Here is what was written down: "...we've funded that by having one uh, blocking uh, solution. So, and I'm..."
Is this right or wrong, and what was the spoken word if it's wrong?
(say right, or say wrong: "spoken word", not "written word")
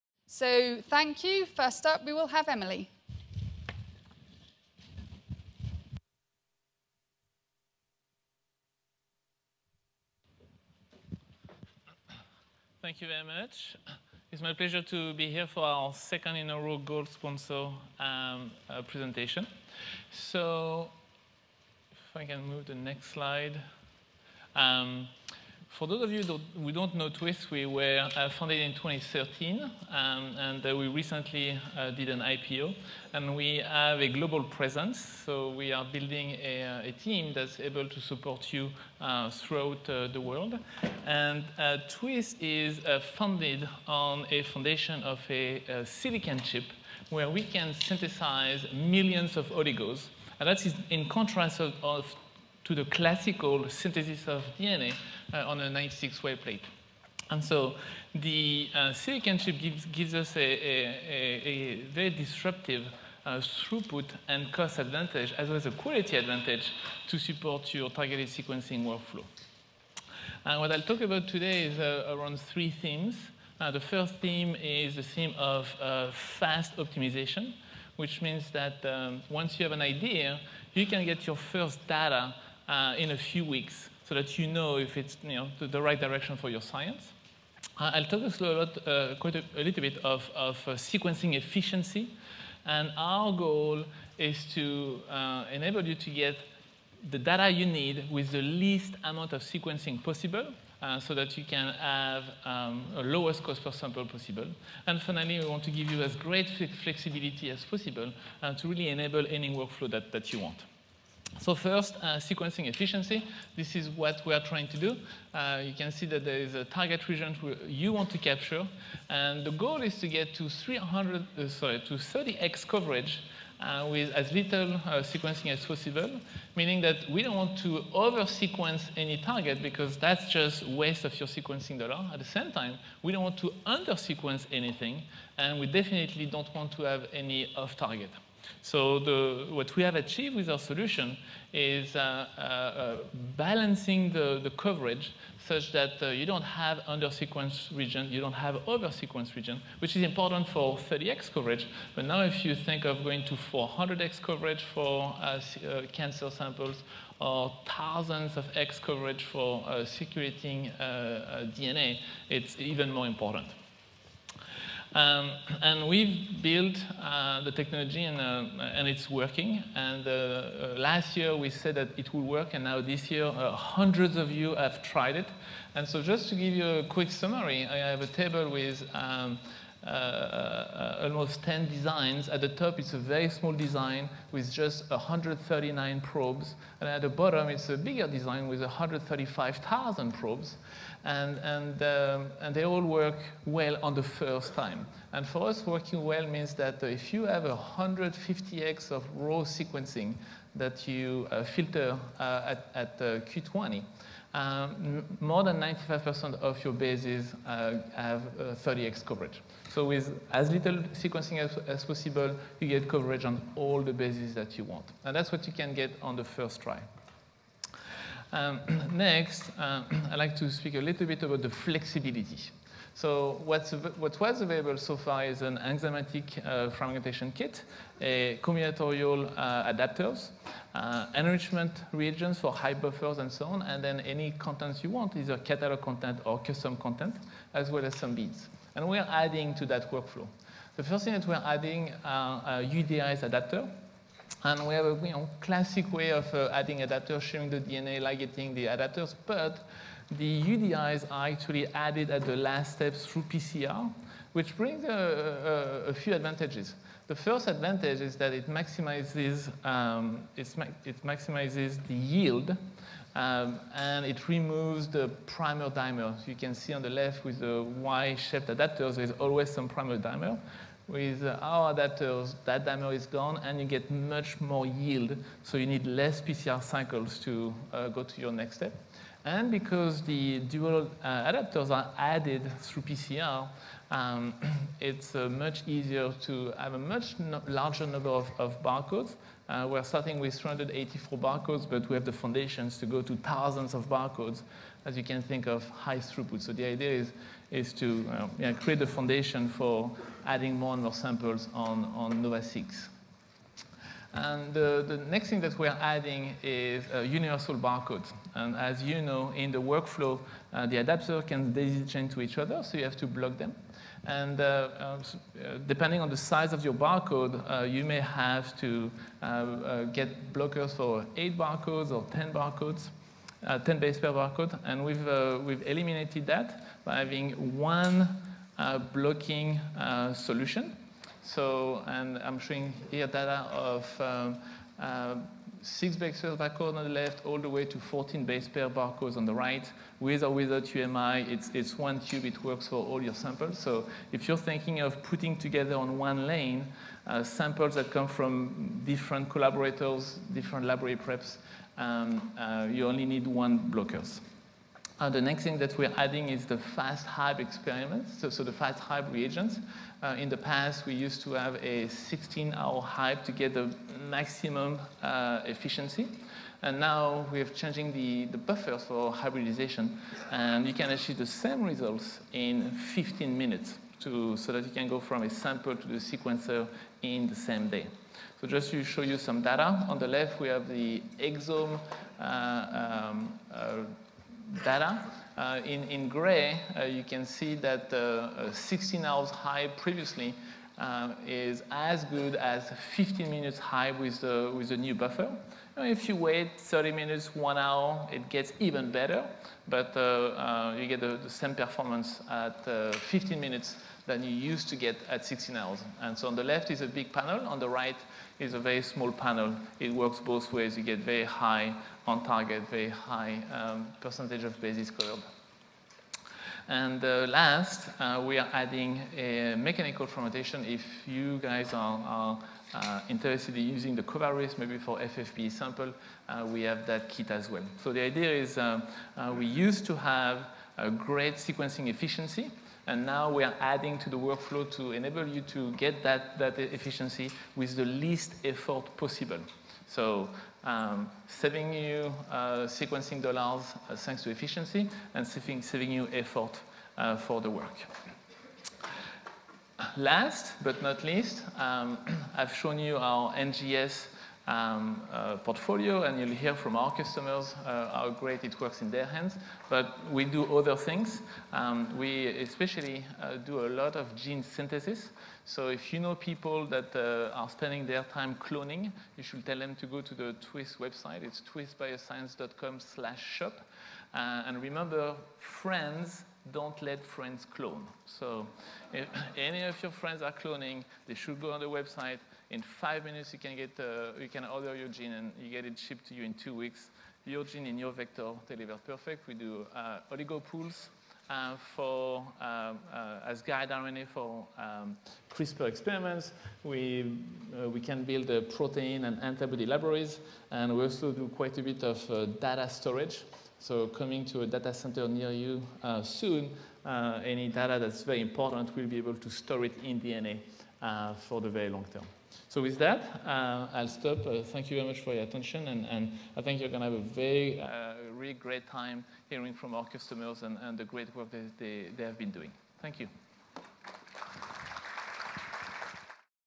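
wrong: "eliminated", not "funded".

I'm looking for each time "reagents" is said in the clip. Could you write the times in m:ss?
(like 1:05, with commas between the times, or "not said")
3:51, 5:59.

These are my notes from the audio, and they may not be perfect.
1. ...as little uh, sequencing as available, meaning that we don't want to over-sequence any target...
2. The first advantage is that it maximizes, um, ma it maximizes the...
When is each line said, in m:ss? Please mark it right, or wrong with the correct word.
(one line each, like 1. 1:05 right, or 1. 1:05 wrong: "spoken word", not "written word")
1. 2:04 wrong: "possible", not "available"
2. 4:17 right.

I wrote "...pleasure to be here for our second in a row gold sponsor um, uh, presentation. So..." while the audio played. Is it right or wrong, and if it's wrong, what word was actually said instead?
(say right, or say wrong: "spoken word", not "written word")
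right.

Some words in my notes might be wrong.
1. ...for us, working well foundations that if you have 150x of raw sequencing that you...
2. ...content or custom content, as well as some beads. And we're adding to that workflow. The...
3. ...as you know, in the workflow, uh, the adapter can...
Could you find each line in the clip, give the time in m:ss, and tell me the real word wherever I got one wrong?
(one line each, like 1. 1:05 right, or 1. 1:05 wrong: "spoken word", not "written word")
1. 3:15 wrong: "means", not "foundations"
2. 3:55 right
3. 5:08 right.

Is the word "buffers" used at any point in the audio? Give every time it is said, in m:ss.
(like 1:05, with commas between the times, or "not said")
3:52, 6:08, 6:34.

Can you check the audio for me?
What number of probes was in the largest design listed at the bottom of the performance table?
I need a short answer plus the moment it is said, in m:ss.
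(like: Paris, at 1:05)
135,000, at 3:08.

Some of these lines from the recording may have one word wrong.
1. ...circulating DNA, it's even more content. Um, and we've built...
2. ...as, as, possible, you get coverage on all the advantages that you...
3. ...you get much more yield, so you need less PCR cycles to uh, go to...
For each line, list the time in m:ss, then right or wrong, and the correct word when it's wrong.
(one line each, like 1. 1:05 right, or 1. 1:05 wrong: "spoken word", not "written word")
1. 2:39 wrong: "important", not "content"
2. 3:31 wrong: "bases", not "advantages"
3. 4:33 right.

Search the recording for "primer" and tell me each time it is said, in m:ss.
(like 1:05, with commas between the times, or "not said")
4:25, 4:29.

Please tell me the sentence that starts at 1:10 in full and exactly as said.
And what I'll talk about today is uh, around three themes.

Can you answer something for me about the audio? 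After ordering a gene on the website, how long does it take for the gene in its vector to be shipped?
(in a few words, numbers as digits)
2 weeks.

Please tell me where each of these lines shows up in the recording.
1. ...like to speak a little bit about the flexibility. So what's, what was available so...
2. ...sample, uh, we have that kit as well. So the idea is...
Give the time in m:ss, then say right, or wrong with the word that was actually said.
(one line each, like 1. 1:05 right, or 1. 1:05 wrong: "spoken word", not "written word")
1. 3:40 right
2. 7:05 right.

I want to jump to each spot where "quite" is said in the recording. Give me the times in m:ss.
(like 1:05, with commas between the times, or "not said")
1:29, 8:21.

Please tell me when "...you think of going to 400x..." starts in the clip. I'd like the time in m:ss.
2:32.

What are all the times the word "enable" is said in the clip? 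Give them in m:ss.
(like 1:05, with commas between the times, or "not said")
1:35, 1:48, 7:14.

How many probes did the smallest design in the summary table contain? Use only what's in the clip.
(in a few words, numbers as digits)
139.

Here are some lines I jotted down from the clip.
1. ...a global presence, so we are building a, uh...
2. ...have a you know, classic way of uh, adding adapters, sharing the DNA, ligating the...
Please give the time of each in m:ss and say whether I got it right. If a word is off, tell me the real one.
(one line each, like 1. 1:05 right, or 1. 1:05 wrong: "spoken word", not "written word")
1. 0:34 right
2. 4:04 right.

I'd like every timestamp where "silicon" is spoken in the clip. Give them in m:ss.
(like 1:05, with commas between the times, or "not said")
0:45, 0:58.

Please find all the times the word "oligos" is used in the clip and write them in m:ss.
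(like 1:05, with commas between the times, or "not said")
0:49, 8:10.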